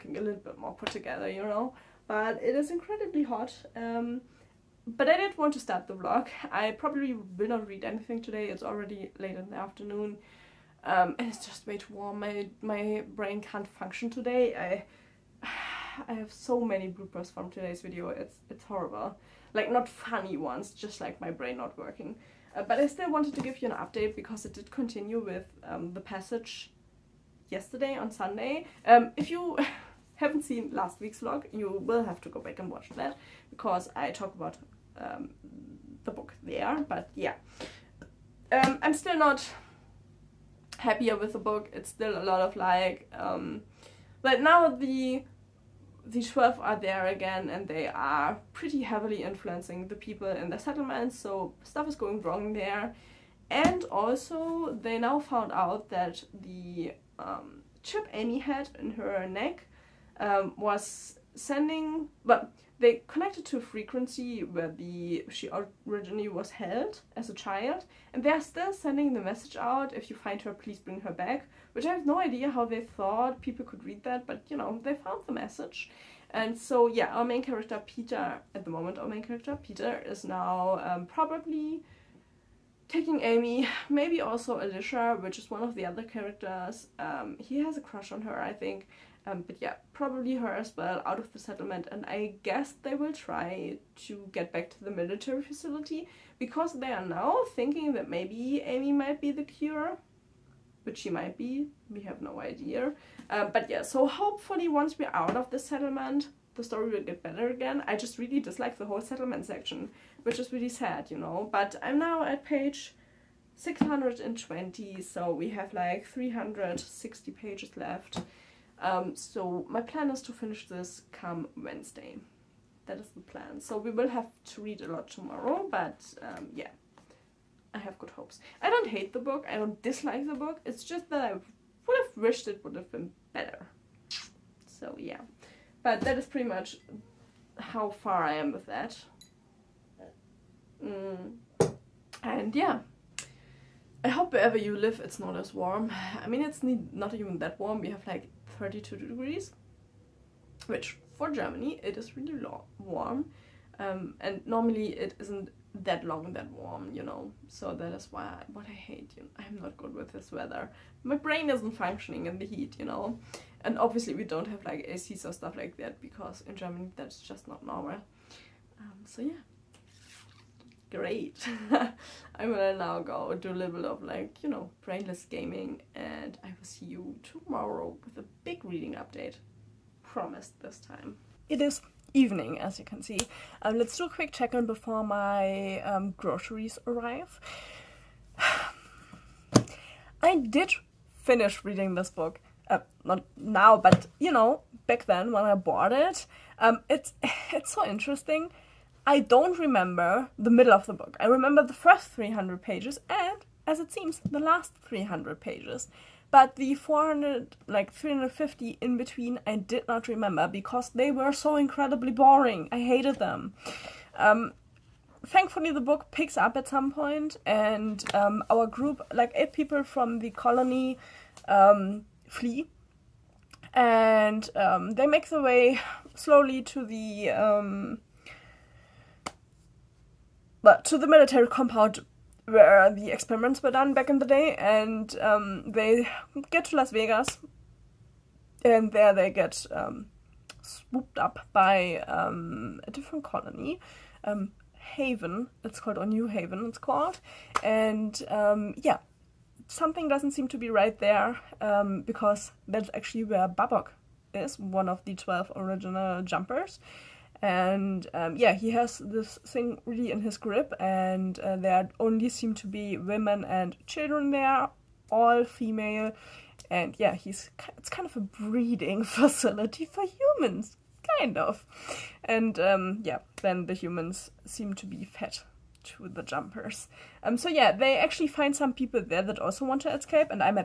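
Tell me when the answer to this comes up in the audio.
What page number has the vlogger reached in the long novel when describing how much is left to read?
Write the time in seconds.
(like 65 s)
112 s.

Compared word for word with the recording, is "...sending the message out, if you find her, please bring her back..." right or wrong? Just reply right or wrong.
right.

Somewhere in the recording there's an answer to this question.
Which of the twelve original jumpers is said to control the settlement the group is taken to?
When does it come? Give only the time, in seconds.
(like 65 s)
253 s.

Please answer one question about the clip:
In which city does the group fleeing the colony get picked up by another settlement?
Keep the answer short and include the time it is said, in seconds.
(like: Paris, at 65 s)
Las Vegas, at 236 s.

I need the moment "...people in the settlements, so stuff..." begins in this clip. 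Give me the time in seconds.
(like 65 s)
49 s.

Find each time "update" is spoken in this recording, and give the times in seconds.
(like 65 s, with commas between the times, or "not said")
23 s, 178 s.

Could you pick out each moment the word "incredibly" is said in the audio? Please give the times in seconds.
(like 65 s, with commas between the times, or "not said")
2 s, 211 s.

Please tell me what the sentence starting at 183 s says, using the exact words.
Um, let's do a quick check-in before my um, groceries arrive.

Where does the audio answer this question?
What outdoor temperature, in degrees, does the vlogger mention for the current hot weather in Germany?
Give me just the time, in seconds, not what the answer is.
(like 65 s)
148 s.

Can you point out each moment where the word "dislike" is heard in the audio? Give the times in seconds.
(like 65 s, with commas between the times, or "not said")
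108 s, 129 s.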